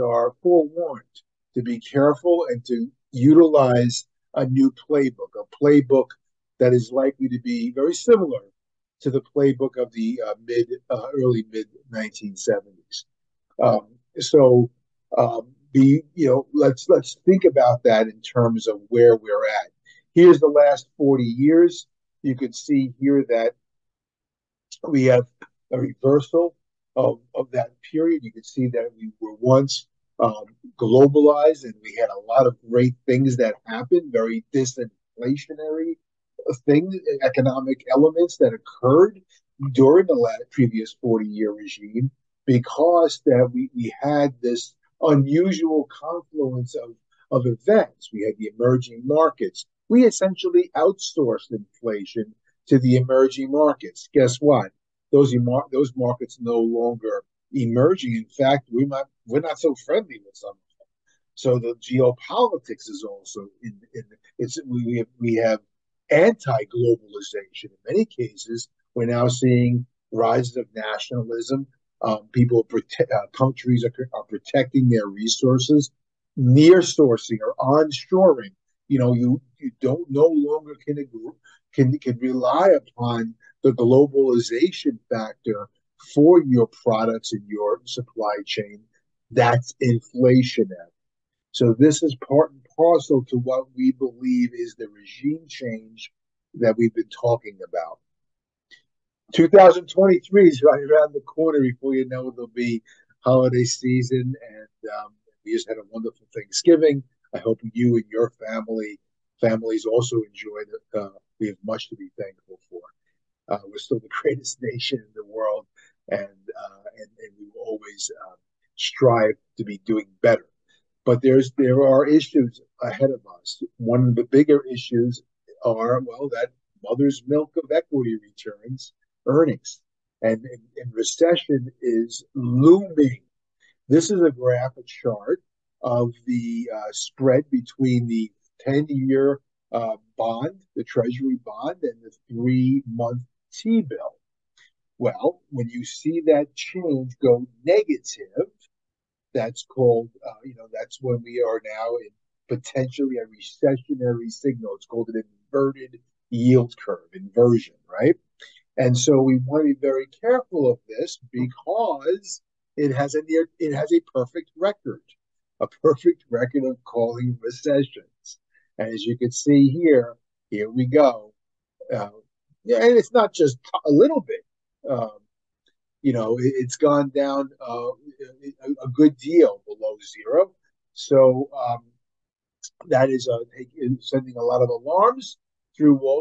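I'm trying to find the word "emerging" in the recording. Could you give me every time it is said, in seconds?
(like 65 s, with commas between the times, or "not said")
48 s, 52 s, 57 s.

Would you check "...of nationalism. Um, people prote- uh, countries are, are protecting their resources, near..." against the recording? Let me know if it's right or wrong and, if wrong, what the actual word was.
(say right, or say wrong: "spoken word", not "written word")
right.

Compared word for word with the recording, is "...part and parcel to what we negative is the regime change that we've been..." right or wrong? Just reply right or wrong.
wrong.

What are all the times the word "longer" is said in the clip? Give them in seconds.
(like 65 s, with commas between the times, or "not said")
56 s, 80 s.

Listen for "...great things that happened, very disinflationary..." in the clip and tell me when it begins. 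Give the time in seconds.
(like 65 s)
32 s.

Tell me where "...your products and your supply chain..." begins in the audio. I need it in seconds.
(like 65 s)
86 s.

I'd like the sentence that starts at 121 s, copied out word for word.
But there's there are issues ahead of us.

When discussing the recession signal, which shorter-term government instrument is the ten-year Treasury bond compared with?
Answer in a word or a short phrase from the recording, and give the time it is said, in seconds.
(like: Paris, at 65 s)
three-month T-bill, at 142 s.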